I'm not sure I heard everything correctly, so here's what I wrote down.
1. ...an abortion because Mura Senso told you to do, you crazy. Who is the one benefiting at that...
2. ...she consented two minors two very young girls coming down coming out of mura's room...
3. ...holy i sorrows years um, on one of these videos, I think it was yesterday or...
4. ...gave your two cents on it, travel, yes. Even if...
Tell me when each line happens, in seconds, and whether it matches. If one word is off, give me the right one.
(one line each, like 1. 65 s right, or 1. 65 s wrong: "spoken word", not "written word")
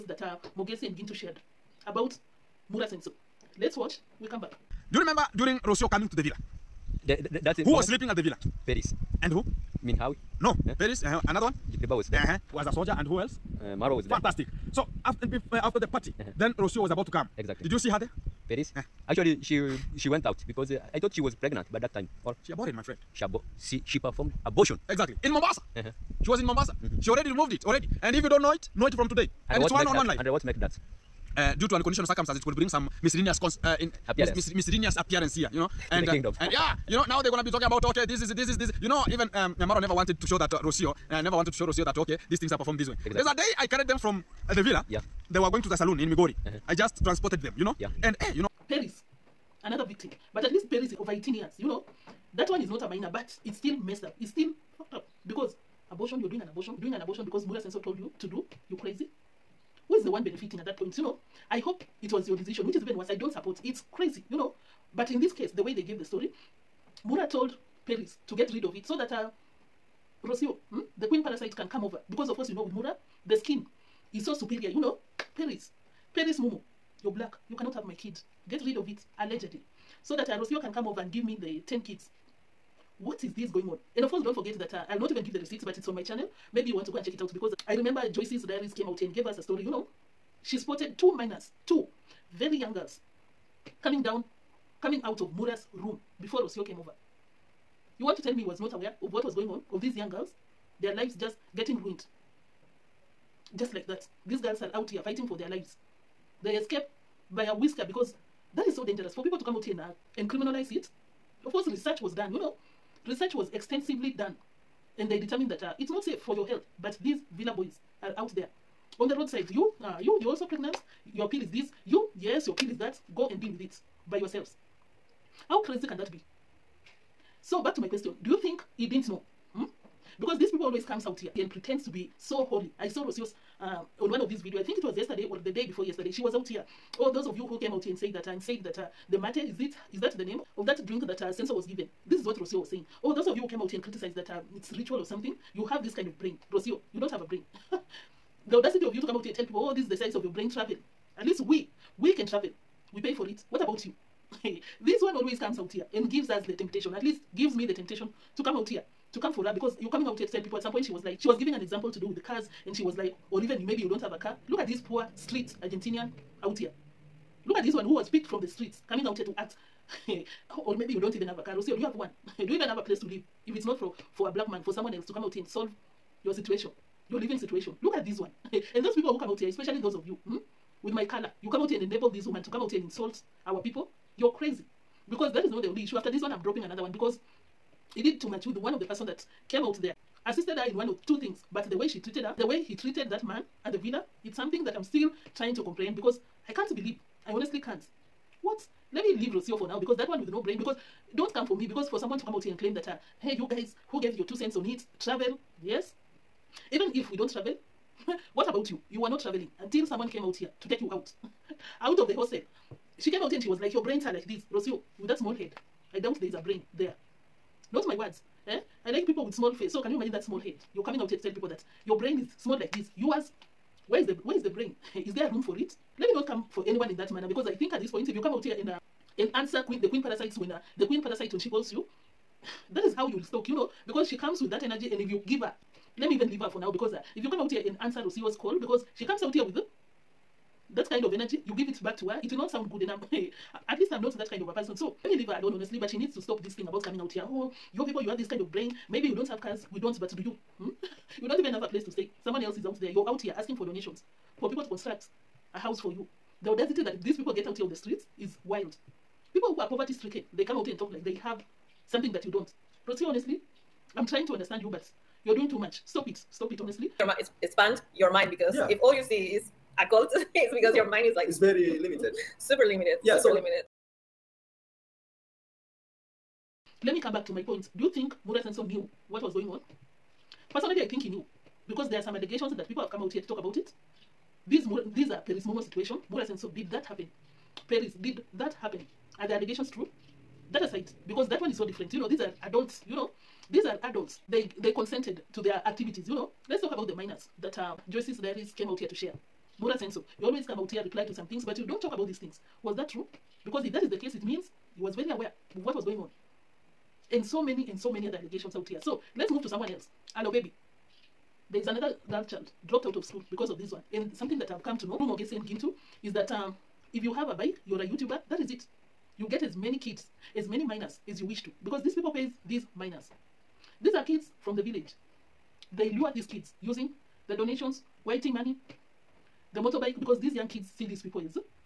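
1. 56 s right
2. 90 s wrong: "spotted", not "consented"
3. 132 s wrong: "yours", not "years"
4. 204 s right.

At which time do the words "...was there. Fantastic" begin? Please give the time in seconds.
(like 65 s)
13 s.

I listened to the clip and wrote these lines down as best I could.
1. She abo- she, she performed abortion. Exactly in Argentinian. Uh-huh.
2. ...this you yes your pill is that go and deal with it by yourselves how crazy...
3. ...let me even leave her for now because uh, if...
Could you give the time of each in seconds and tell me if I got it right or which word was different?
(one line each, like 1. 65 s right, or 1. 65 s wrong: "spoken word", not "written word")
1. 23 s wrong: "Mombasa", not "Argentinian"
2. 121 s right
3. 235 s right.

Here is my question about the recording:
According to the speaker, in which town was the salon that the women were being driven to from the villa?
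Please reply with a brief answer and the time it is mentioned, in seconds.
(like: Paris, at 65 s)
Migori, at 46 s.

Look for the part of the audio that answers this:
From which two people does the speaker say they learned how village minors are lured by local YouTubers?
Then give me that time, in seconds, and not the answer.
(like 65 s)
315 s.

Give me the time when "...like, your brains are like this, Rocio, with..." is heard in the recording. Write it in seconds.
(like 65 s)
213 s.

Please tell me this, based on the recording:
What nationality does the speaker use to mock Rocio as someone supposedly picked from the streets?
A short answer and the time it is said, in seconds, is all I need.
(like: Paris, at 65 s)
Argentinian, at 165 s.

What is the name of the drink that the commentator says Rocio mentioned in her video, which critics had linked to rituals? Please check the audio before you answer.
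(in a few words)
mate.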